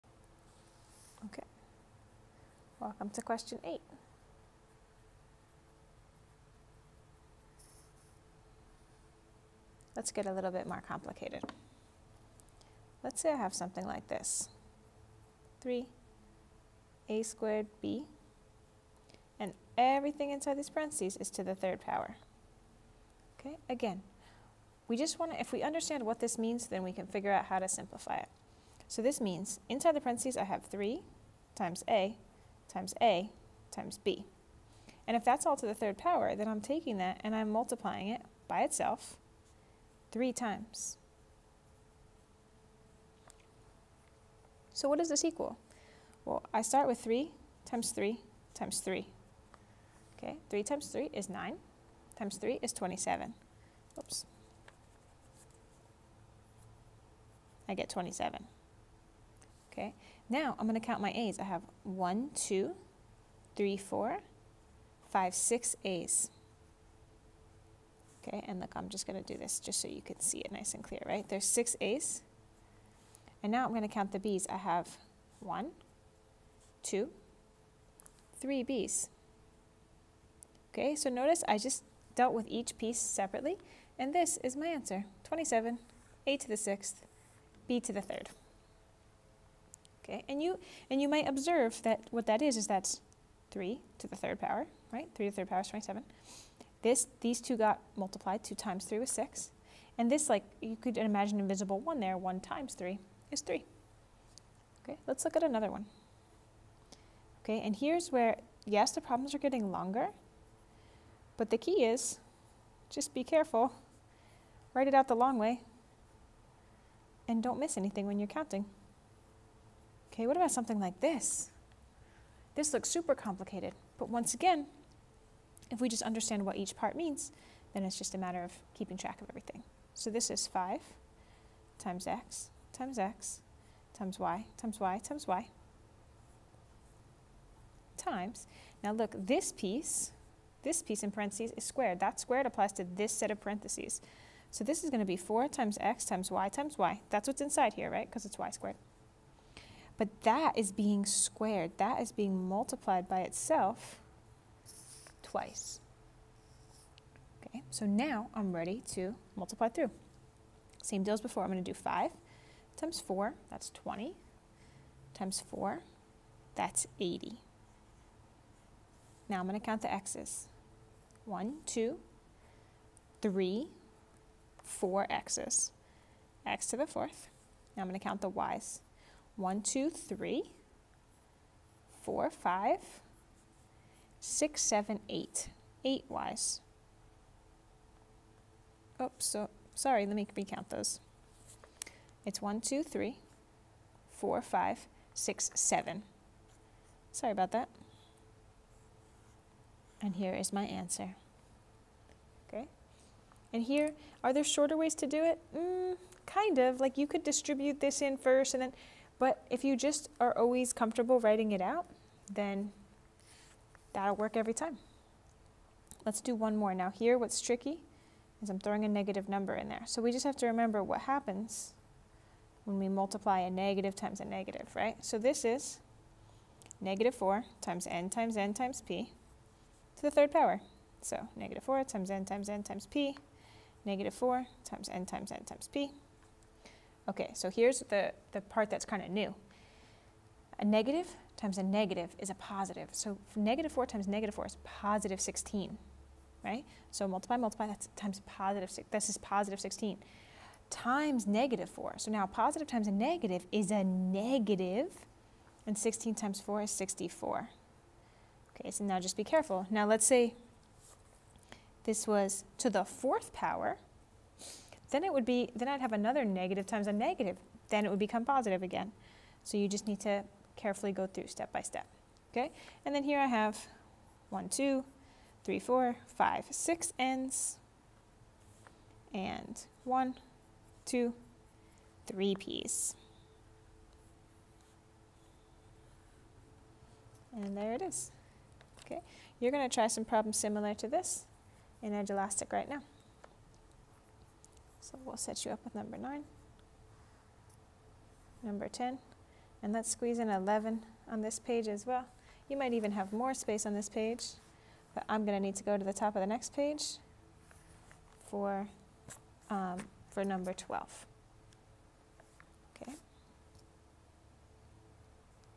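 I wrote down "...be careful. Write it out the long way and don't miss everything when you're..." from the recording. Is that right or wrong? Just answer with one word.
wrong.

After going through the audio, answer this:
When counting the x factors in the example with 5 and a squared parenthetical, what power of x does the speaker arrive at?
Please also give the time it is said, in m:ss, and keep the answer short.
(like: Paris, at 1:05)
x to the fourth, at 2:56.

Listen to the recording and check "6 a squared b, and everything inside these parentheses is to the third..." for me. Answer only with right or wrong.
wrong.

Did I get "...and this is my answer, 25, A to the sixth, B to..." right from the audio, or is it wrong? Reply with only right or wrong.
wrong.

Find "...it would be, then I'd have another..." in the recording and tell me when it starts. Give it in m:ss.
4:25.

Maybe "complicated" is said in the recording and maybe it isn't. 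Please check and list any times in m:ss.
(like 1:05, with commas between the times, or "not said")
0:10, 2:03.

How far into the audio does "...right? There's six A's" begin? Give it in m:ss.
1:11.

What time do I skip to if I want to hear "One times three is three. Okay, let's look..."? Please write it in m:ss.
1:42.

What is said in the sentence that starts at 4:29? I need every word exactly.
So you just need to carefully go through step by step.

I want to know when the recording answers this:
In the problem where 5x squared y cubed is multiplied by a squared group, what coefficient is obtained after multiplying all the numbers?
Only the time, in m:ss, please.
2:46.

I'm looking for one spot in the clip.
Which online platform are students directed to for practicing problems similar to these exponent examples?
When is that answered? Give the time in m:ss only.
4:51.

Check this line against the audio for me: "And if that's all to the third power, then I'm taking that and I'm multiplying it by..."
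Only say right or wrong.
right.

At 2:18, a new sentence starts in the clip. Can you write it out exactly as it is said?
Now look, this piece, this piece in parentheses is squared.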